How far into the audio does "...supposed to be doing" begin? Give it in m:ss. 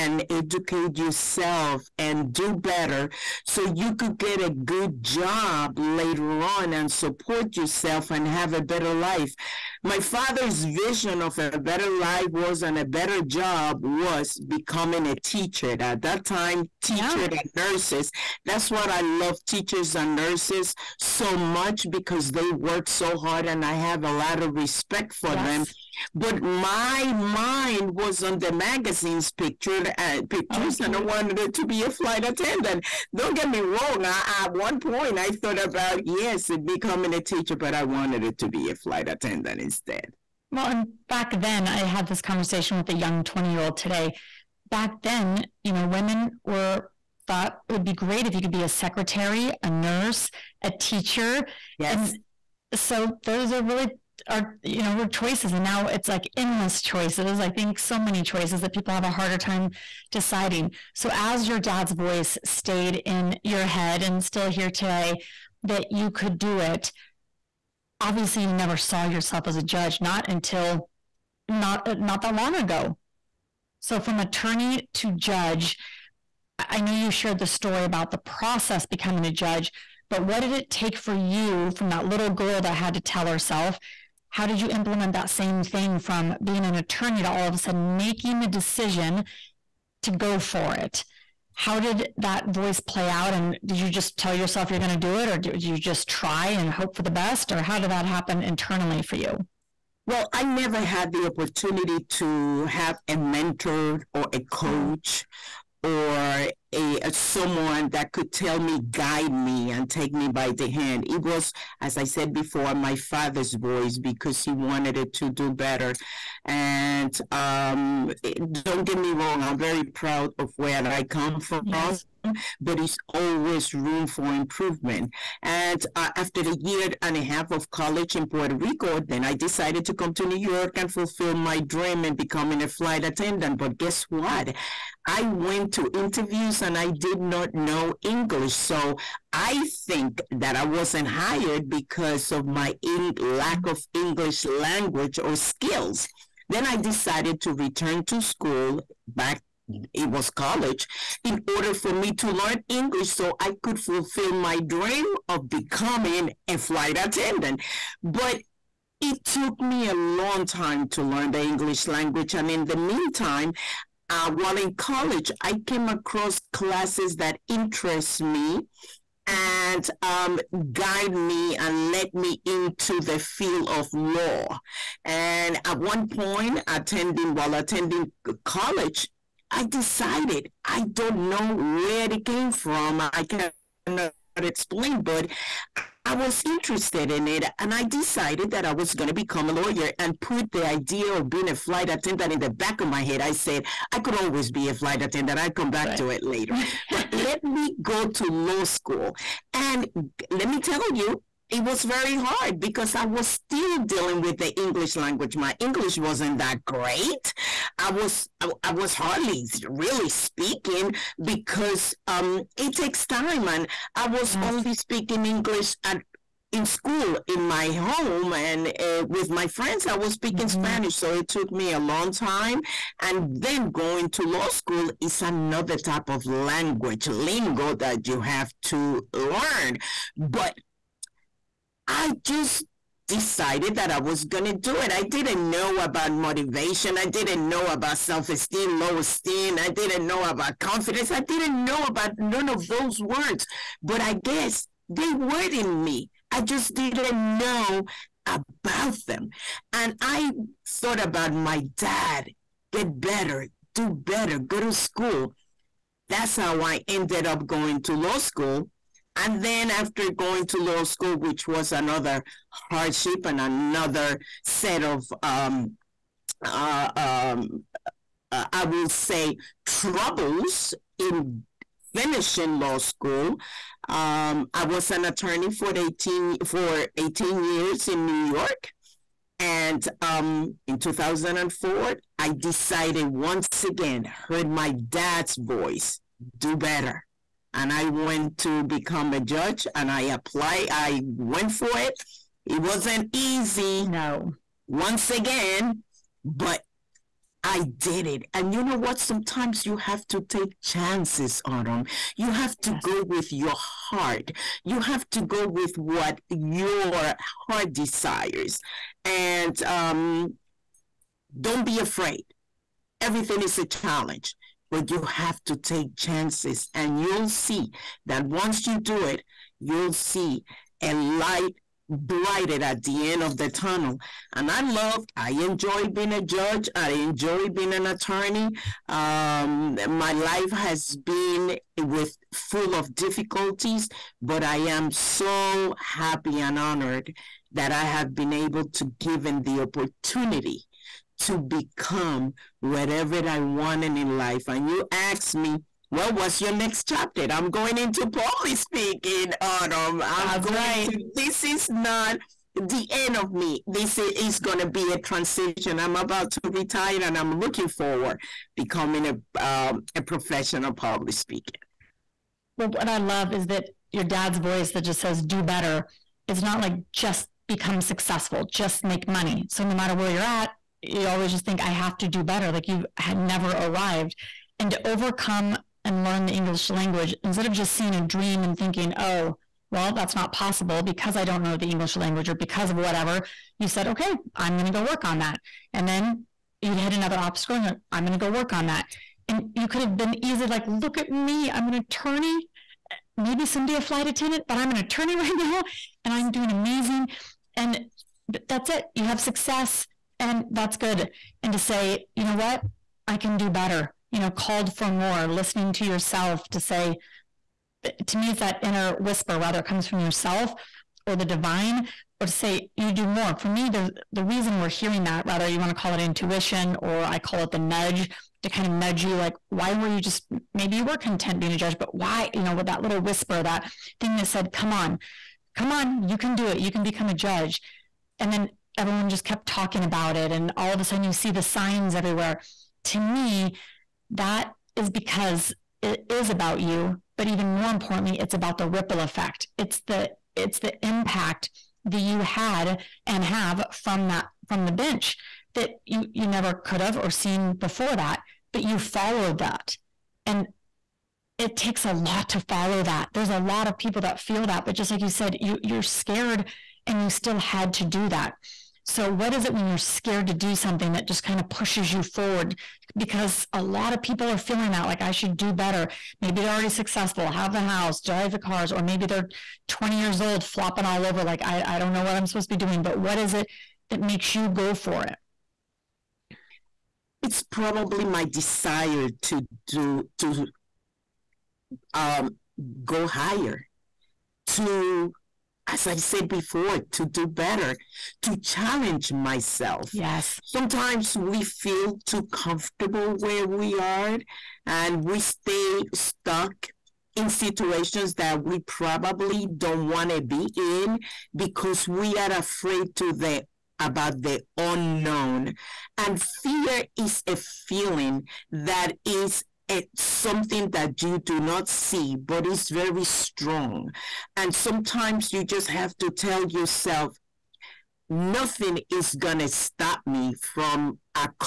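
7:52.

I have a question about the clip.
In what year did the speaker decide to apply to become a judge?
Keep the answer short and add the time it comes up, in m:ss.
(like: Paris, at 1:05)
2004, at 4:40.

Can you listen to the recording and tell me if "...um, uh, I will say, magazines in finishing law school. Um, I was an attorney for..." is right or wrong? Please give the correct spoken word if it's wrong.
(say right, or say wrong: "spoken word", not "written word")
wrong: "troubles", not "magazines".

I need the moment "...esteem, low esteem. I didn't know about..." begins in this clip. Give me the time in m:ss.
3:58.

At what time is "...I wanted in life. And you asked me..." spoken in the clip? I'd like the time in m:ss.
5:43.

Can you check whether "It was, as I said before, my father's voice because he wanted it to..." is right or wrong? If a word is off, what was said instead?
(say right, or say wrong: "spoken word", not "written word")
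right.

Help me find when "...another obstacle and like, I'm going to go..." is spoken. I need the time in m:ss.
6:26.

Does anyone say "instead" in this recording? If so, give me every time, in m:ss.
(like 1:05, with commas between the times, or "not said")
0:39, 6:17.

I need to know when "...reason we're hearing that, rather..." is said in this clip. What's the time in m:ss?
6:54.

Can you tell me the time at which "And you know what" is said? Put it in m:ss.
4:58.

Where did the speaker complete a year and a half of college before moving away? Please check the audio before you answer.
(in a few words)
Puerto Rico.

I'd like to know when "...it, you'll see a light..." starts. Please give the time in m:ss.
5:19.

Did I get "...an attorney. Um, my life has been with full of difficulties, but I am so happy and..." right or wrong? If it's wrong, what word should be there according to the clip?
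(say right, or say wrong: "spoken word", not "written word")
right.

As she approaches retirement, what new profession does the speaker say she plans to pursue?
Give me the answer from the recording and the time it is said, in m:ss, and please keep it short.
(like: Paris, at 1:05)
professional public speaker, at 6:00.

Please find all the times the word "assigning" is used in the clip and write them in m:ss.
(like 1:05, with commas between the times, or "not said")
not said.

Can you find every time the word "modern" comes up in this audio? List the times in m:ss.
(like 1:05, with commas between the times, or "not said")
not said.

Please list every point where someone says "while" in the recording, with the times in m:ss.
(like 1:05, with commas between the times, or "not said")
2:44, 2:57.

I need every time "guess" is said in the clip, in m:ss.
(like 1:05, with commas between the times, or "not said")
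2:13, 4:04.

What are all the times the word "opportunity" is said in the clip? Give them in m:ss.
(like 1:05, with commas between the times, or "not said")
1:41, 5:39.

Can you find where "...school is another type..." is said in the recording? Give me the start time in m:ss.
3:44.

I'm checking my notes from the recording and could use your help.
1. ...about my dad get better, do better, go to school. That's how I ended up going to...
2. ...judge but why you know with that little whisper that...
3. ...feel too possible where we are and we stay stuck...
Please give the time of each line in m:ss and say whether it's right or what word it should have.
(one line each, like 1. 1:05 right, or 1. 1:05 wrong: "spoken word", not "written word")
1. 4:10 right
2. 7:01 right
3. 8:11 wrong: "comfortable", not "possible".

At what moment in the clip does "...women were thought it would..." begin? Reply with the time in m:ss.
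0:45.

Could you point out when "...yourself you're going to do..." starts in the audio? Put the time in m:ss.
1:34.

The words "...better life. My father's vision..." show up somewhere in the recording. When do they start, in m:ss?
0:08.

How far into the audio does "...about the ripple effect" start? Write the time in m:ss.
7:18.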